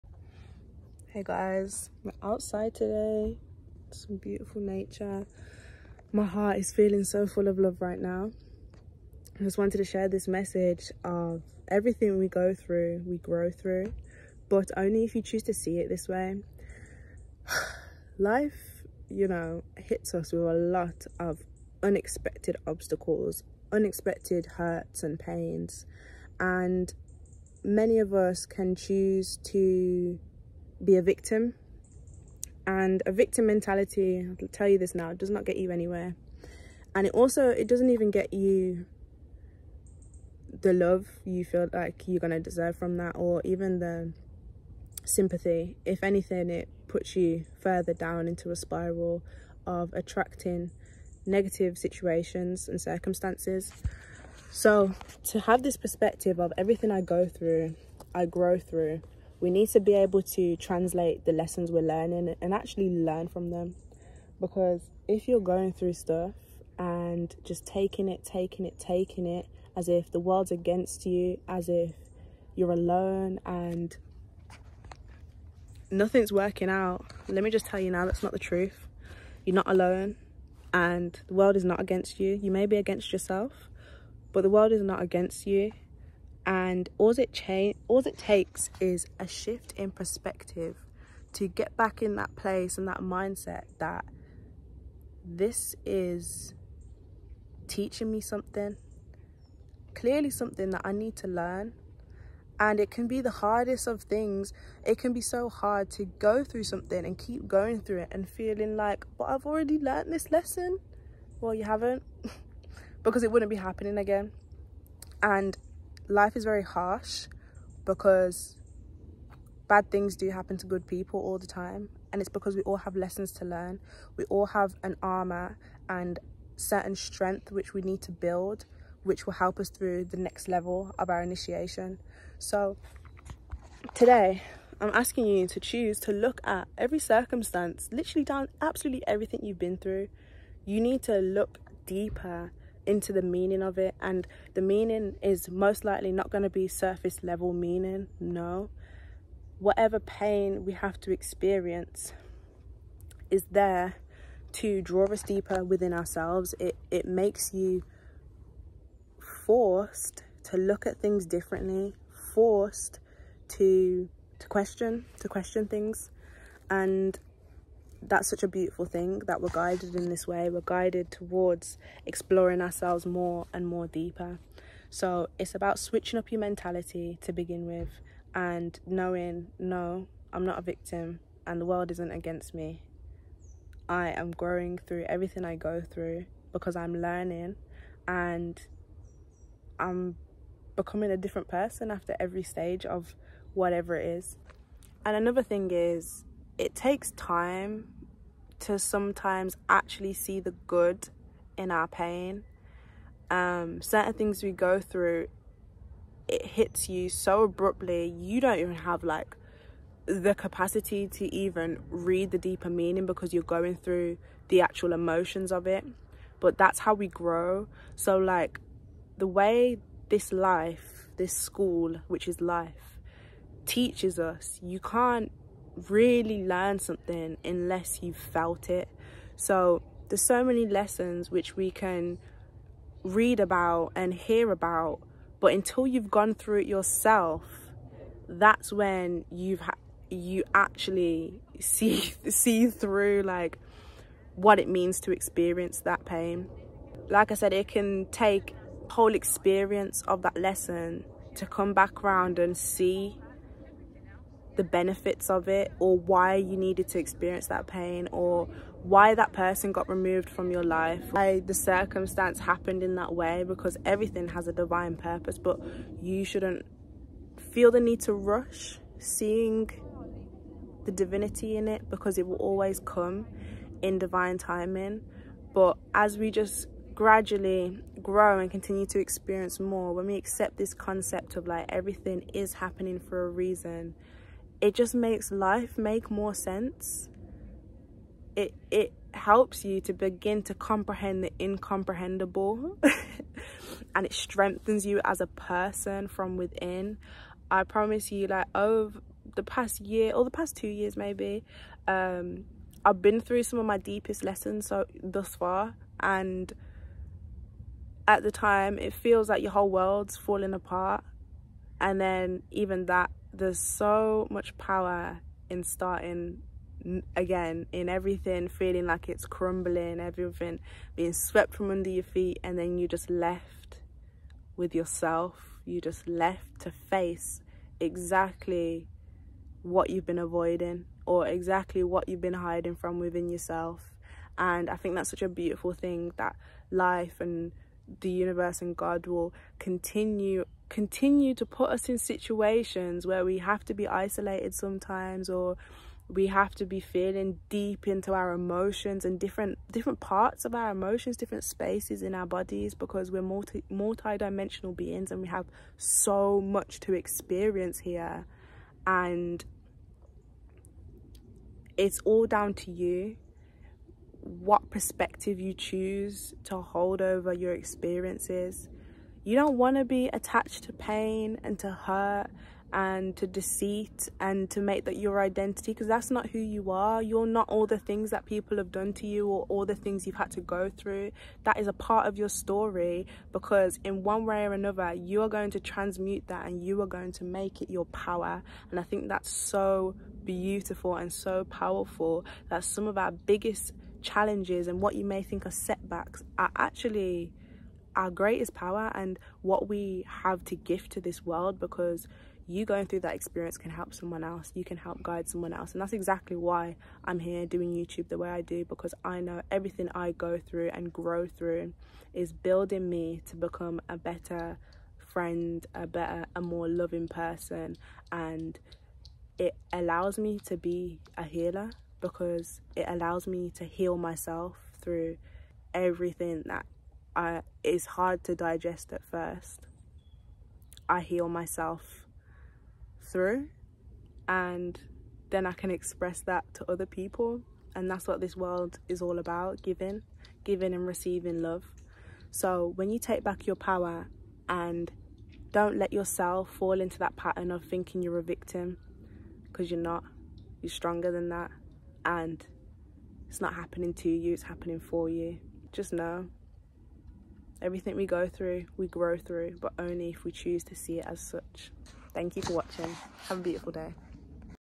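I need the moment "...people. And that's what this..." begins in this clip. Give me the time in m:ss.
7:16.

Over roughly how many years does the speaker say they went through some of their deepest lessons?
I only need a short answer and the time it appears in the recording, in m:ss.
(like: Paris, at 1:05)
2, at 5:00.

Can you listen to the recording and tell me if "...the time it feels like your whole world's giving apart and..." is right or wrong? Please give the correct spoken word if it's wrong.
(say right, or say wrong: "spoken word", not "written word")
wrong: "falling", not "giving".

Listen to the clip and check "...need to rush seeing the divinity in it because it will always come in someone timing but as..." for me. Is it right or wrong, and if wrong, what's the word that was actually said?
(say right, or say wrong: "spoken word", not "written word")
wrong: "divine", not "someone".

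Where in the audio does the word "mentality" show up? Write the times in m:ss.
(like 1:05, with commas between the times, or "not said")
0:33, 2:56.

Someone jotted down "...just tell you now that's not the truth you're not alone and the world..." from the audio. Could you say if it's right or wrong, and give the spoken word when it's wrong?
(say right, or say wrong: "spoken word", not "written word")
right.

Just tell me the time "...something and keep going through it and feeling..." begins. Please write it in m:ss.
1:46.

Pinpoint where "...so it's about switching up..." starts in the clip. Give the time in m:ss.
2:54.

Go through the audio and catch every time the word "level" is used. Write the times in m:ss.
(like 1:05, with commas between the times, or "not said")
2:10, 2:27.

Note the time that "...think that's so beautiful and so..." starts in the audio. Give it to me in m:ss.
6:28.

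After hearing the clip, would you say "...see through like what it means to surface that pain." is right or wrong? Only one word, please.
wrong.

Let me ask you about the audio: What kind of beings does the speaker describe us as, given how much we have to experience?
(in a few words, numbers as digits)
multi-dimensional.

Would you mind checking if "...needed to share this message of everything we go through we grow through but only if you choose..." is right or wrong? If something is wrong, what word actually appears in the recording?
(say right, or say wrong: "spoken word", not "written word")
wrong: "wanted", not "needed".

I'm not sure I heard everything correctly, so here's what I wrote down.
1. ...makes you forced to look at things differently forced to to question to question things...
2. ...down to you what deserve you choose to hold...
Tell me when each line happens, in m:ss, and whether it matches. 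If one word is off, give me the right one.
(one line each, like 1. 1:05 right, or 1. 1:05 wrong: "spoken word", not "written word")
1. 2:37 right
2. 6:02 wrong: "perspective", not "deserve".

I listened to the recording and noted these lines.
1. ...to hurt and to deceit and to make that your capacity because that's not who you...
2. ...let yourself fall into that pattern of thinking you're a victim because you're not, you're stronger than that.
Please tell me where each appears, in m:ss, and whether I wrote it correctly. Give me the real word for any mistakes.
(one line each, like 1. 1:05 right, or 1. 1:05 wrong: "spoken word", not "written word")
1. 6:11 wrong: "identity", not "capacity"
2. 7:25 right.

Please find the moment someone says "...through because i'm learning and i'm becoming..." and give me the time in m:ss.
3:05.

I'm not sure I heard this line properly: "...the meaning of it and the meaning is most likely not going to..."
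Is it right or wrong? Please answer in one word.
right.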